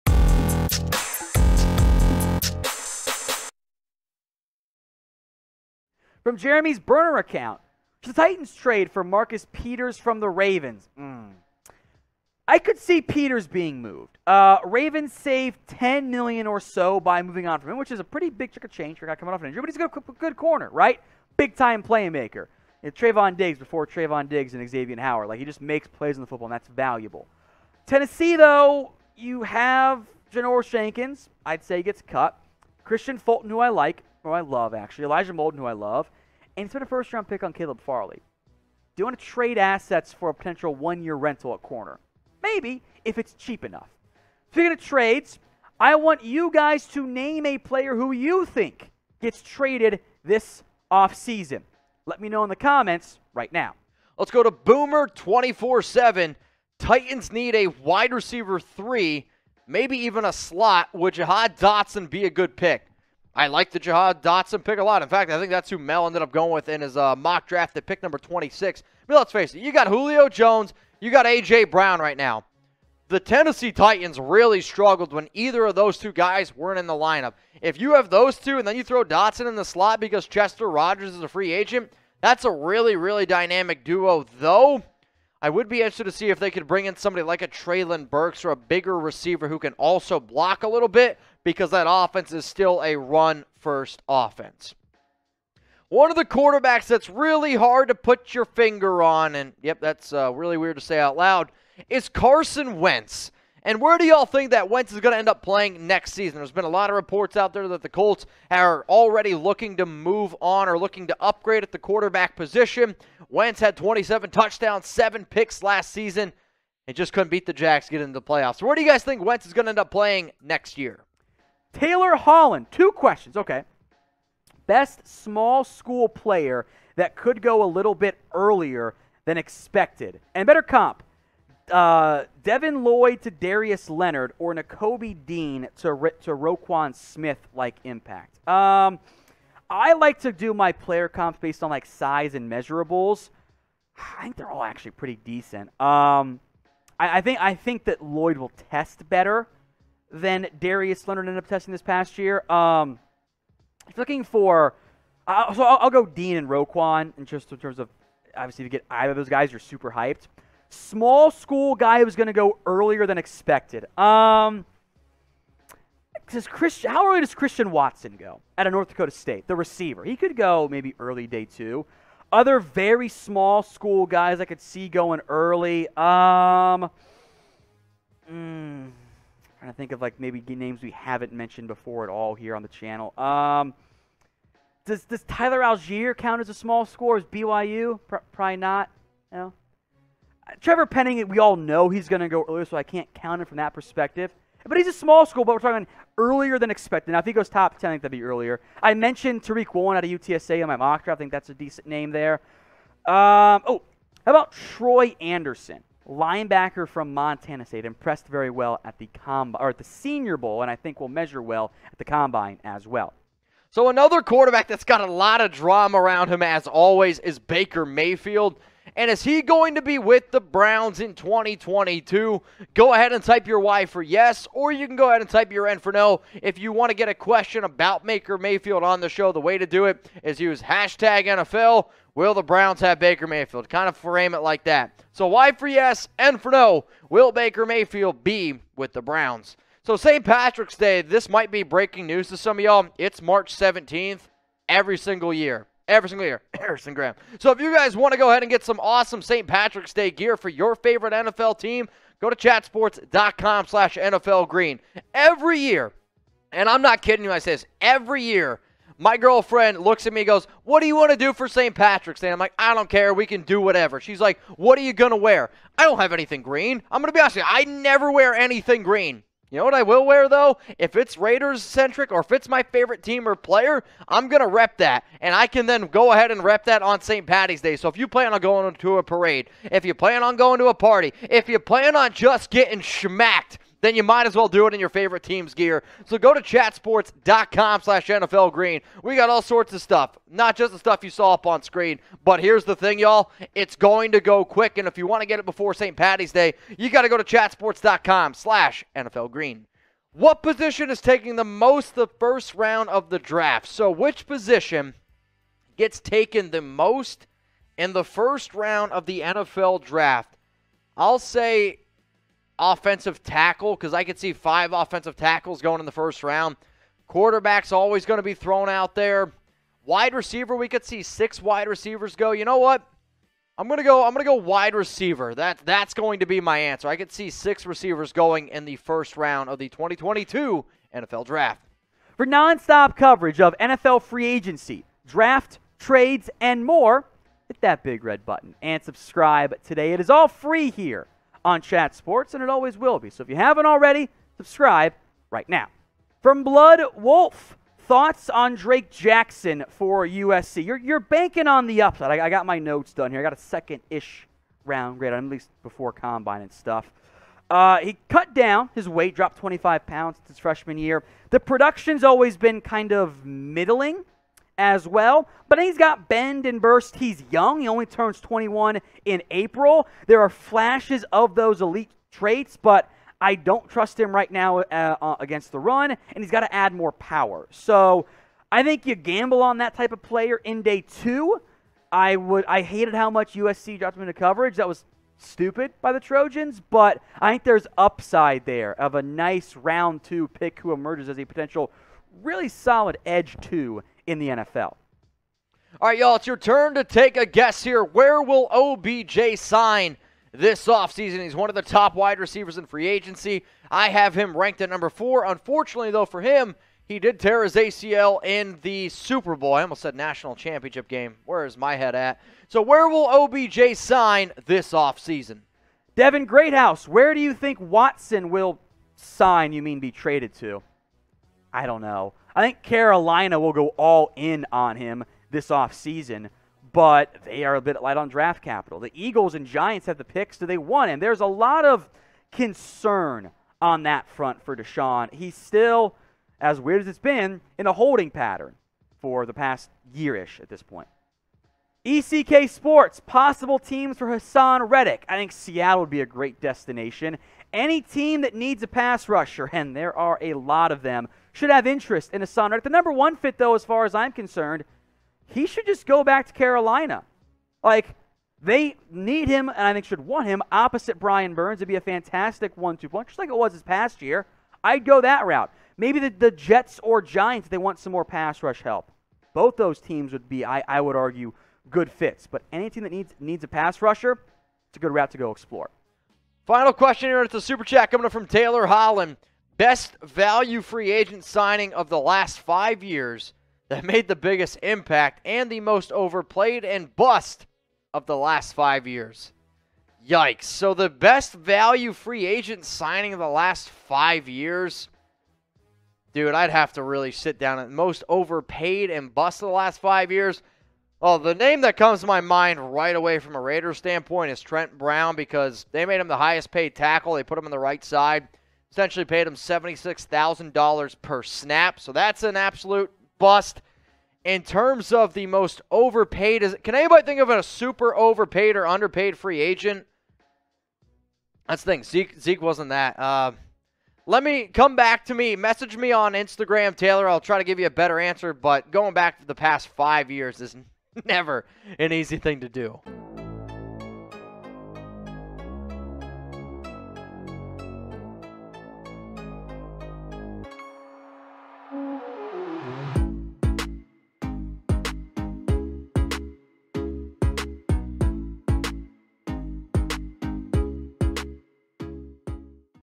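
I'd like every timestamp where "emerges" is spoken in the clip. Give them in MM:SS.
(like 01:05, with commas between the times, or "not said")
06:30.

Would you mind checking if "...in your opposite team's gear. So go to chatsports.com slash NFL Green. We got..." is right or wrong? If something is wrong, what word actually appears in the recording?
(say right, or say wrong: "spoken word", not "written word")
wrong: "favorite", not "opposite".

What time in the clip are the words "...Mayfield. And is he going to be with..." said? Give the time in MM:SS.
03:37.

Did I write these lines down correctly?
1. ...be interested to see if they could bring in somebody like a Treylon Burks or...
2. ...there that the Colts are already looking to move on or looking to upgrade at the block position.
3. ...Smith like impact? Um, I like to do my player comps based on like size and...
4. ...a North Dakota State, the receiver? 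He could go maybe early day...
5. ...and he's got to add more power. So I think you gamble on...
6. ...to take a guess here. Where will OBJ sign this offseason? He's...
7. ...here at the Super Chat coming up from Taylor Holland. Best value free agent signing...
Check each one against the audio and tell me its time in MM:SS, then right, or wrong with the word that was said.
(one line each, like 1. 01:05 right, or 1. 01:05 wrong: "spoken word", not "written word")
1. 01:25 right
2. 01:47 wrong: "quarterback", not "block"
3. 02:16 right
4. 02:48 right
5. 06:15 right
6. 06:36 right
7. 07:57 right.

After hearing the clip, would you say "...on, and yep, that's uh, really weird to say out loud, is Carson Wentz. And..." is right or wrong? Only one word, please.
right.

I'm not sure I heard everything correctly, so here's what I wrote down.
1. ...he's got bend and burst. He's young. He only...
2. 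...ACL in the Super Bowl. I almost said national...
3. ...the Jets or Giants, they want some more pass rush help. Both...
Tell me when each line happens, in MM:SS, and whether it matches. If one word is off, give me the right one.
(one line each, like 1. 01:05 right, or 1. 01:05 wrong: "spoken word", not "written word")
1. 06:05 right
2. 06:47 right
3. 07:46 right.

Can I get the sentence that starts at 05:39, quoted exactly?
It is all free here on Chat Sports, and it always will be.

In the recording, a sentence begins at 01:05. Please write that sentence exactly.
In fact, I think that's who Mel ended up going with in his uh, mock draft at pick number 26.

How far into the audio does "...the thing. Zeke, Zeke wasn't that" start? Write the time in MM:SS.
08:41.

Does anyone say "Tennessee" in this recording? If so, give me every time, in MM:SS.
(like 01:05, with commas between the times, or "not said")
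00:27, 01:13.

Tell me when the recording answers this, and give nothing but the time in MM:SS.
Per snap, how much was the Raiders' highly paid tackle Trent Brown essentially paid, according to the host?
08:29.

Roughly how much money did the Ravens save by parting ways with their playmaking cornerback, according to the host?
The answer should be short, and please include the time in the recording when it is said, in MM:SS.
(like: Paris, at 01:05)
10 million, at 00:15.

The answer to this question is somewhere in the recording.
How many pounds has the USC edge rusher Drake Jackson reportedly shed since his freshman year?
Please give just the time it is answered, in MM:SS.
05:59.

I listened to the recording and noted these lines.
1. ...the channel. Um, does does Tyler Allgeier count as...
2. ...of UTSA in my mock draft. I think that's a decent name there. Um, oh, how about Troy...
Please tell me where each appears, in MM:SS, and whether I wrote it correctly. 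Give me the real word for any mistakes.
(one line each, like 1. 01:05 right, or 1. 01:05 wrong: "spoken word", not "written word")
1. 03:02 right
2. 03:20 right.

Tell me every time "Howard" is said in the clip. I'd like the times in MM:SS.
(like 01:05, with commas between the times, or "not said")
00:24.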